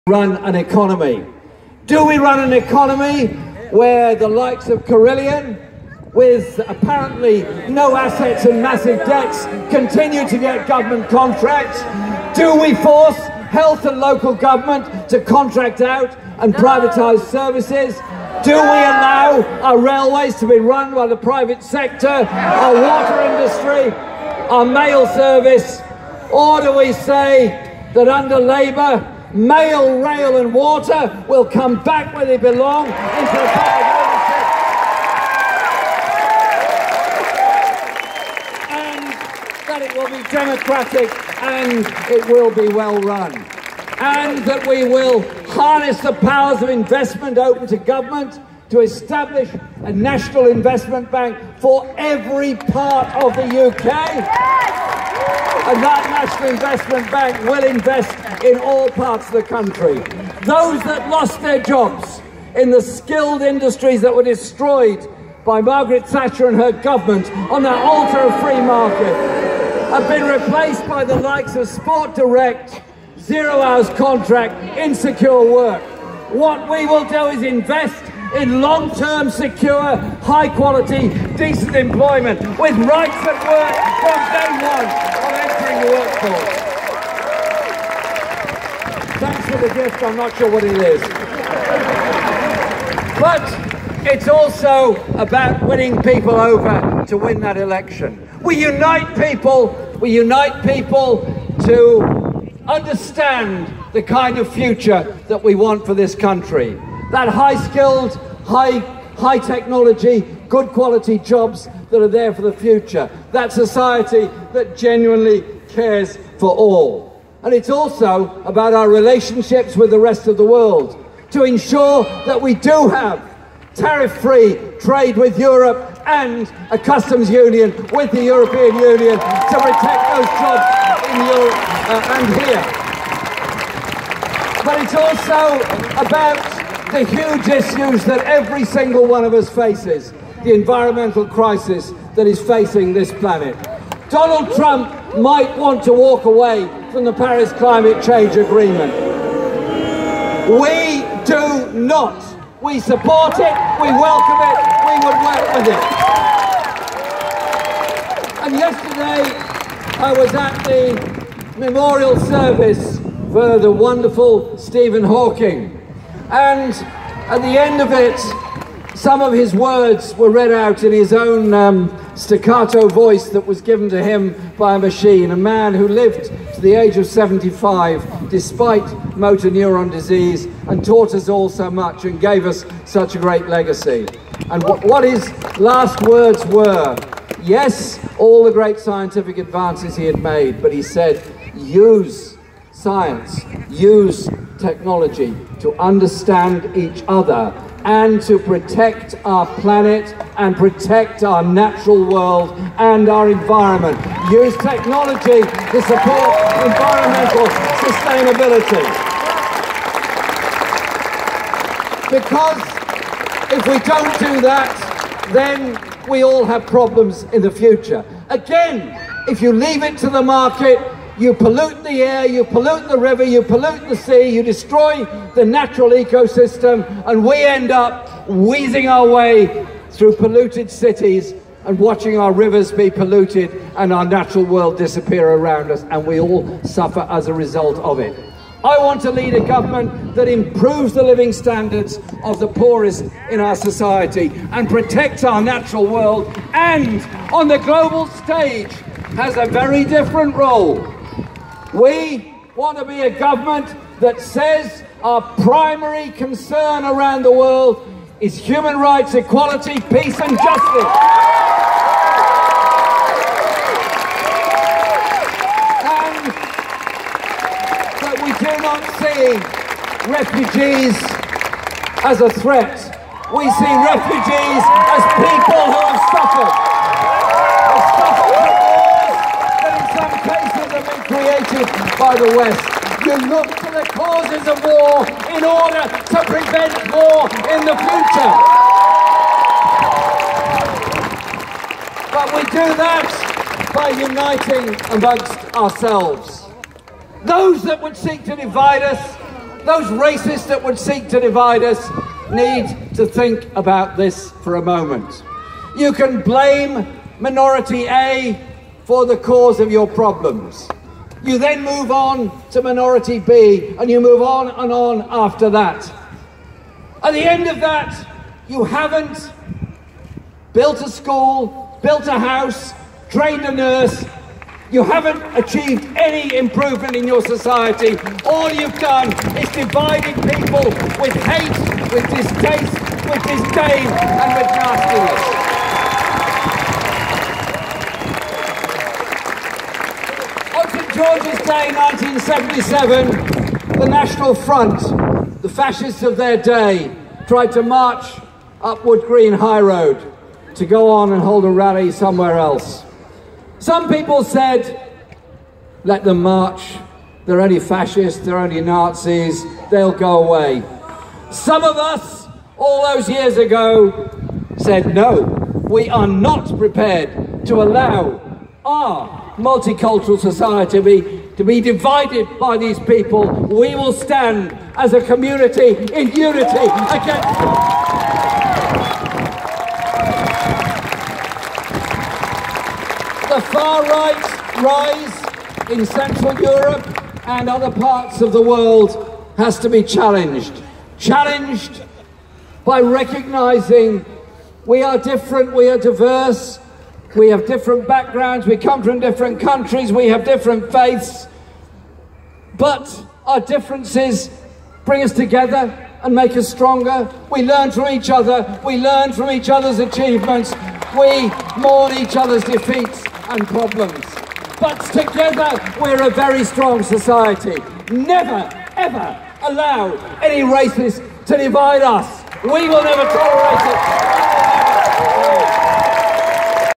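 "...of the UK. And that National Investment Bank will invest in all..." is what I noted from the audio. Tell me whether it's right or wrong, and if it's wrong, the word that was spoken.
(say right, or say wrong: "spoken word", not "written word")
right.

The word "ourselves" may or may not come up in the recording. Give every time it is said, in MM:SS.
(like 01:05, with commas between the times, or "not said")
04:55.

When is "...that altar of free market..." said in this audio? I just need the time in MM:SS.
01:07.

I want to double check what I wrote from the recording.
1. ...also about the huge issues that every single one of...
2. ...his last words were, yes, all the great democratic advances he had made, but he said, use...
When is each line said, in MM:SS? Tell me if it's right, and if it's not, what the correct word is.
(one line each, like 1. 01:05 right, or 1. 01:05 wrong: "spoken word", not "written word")
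1. 02:14 right
2. 03:05 wrong: "scientific", not "democratic".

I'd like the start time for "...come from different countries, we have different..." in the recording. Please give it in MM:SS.
06:38.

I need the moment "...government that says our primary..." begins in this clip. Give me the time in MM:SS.
04:13.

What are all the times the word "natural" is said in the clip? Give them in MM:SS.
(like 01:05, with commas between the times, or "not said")
03:21, 03:45, 03:54, 04:05.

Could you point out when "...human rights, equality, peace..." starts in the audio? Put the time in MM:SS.
04:18.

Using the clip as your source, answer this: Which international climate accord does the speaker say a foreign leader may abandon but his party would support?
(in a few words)
Paris Climate Change Agreement.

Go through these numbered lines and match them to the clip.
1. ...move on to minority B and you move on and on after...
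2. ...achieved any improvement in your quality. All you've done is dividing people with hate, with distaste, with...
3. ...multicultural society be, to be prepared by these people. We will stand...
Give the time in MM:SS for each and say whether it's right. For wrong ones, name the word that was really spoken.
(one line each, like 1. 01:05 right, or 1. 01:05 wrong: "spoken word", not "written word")
1. 05:11 right
2. 05:25 wrong: "society", not "quality"
3. 06:09 wrong: "divided", not "prepared".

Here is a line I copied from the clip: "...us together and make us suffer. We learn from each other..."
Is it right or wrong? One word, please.
wrong.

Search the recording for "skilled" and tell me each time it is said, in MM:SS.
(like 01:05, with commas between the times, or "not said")
01:02, 01:47.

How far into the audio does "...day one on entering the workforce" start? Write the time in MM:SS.
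01:29.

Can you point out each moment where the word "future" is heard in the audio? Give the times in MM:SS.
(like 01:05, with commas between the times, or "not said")
01:44, 01:52, 03:37, 04:47.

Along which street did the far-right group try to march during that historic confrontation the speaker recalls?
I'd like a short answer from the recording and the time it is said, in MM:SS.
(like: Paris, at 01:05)
Wood Green High Road, at 05:48.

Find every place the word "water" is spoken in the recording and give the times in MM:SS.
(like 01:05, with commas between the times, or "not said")
00:22, 00:30.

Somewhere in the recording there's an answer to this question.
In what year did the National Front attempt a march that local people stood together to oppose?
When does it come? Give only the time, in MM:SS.
05:41.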